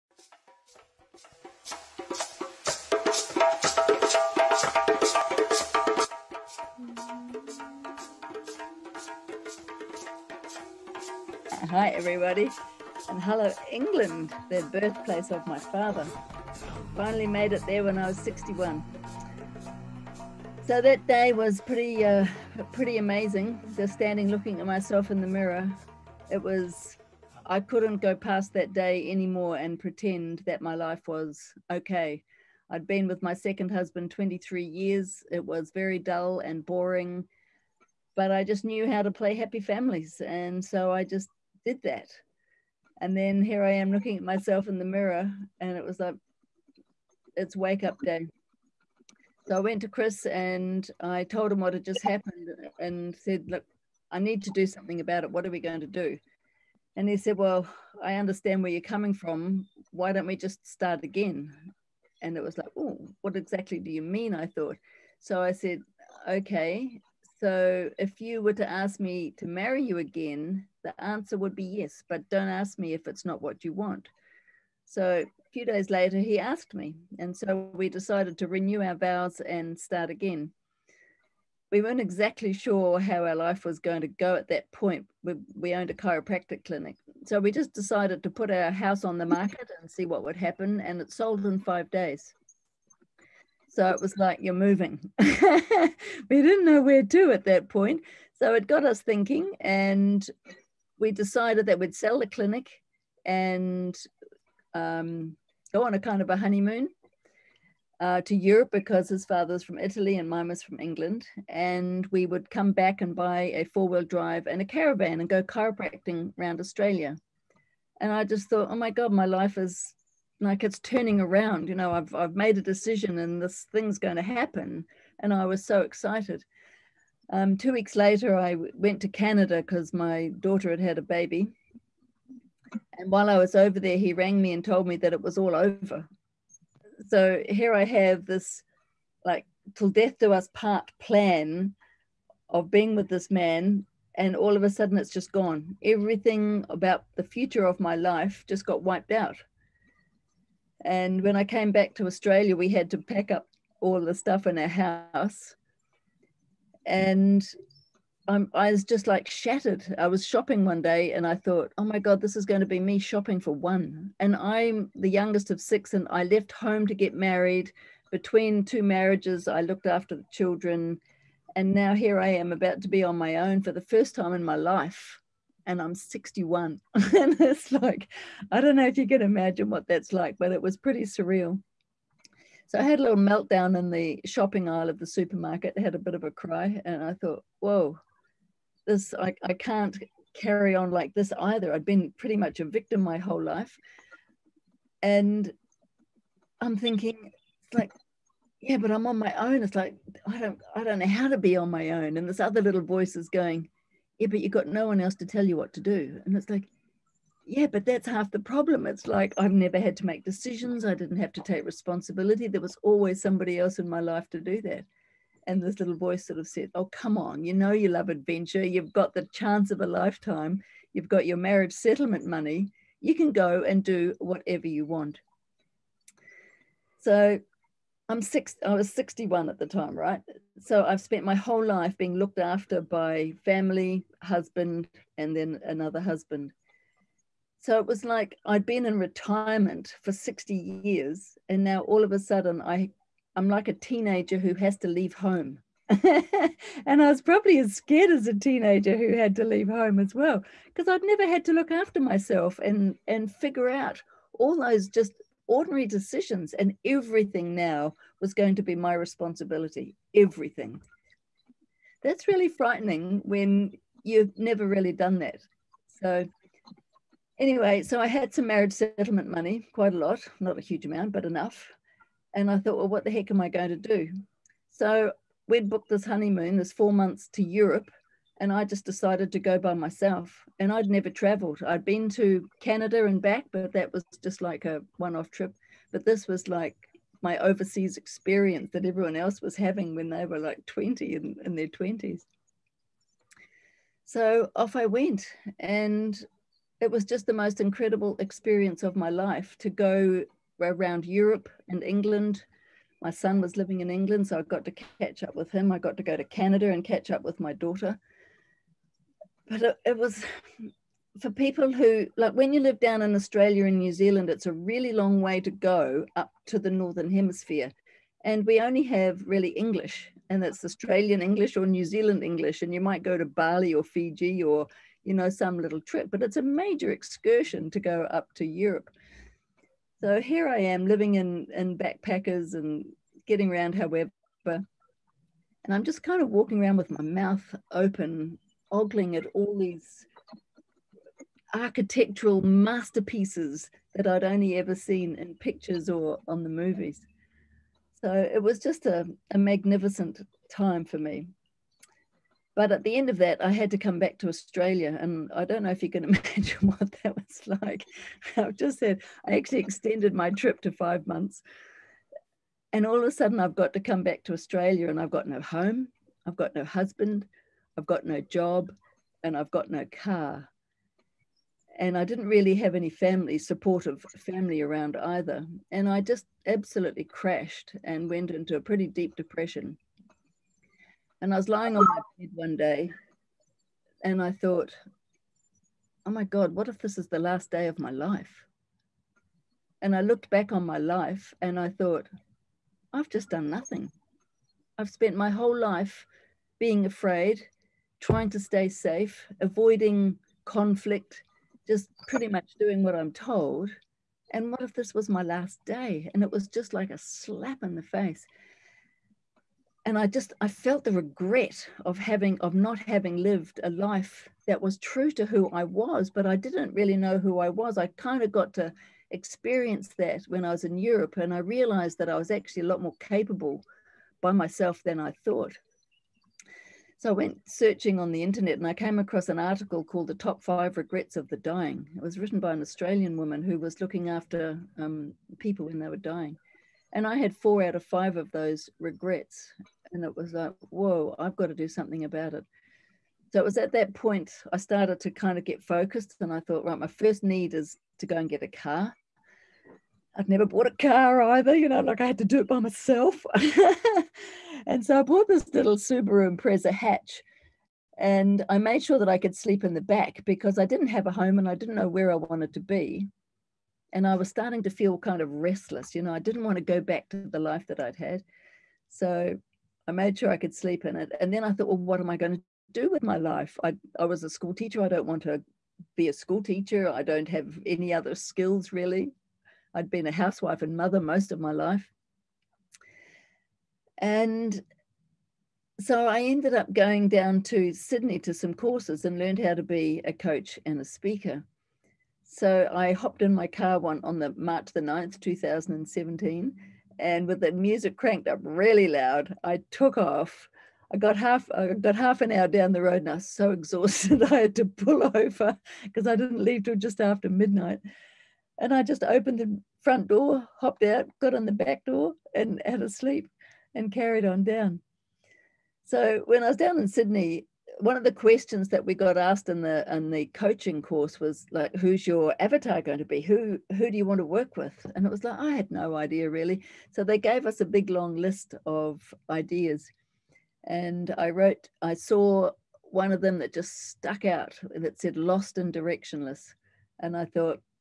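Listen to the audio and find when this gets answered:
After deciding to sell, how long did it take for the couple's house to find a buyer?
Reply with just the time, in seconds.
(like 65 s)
91 s.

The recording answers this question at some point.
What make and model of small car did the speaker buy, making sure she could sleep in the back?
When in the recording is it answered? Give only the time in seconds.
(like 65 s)
455 s.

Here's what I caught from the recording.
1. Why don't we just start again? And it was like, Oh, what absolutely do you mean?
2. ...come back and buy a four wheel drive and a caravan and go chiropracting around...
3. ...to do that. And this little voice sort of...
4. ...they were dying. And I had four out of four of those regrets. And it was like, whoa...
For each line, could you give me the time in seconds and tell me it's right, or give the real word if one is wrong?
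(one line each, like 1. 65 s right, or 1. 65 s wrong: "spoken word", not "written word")
1. 59 s wrong: "exactly", not "absolutely"
2. 112 s right
3. 214 s right
4. 435 s wrong: "five", not "four".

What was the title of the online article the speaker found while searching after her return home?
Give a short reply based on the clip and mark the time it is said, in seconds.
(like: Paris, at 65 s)
The Top Five Regrets of the Dying, at 430 s.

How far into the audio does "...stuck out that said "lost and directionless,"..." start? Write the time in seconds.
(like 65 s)
533 s.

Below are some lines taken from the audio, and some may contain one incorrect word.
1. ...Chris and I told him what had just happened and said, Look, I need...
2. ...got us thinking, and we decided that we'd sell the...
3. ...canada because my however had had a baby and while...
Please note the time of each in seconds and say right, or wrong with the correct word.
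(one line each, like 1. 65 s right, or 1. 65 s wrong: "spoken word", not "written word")
1. 49 s right
2. 98 s right
3. 129 s wrong: "daughter", not "however".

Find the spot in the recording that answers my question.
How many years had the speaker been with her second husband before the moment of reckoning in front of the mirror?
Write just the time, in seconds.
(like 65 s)
34 s.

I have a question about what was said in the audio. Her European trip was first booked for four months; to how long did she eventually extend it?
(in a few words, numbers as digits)
5 months.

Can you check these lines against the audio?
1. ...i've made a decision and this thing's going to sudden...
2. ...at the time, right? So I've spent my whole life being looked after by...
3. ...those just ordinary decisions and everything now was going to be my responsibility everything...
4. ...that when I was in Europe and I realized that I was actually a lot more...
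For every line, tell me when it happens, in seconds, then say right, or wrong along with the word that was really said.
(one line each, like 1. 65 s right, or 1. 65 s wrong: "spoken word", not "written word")
1. 122 s wrong: "happen", not "sudden"
2. 229 s right
3. 254 s right
4. 419 s right.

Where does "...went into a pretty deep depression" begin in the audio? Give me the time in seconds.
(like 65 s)
378 s.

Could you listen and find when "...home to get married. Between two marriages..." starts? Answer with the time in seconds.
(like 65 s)
166 s.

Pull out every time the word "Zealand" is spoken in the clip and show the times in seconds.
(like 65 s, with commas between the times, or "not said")
313 s, 321 s.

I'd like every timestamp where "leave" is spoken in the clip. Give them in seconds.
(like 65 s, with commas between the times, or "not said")
244 s, 249 s, 506 s.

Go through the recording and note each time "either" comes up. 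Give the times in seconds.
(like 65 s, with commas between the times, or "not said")
191 s, 374 s, 451 s.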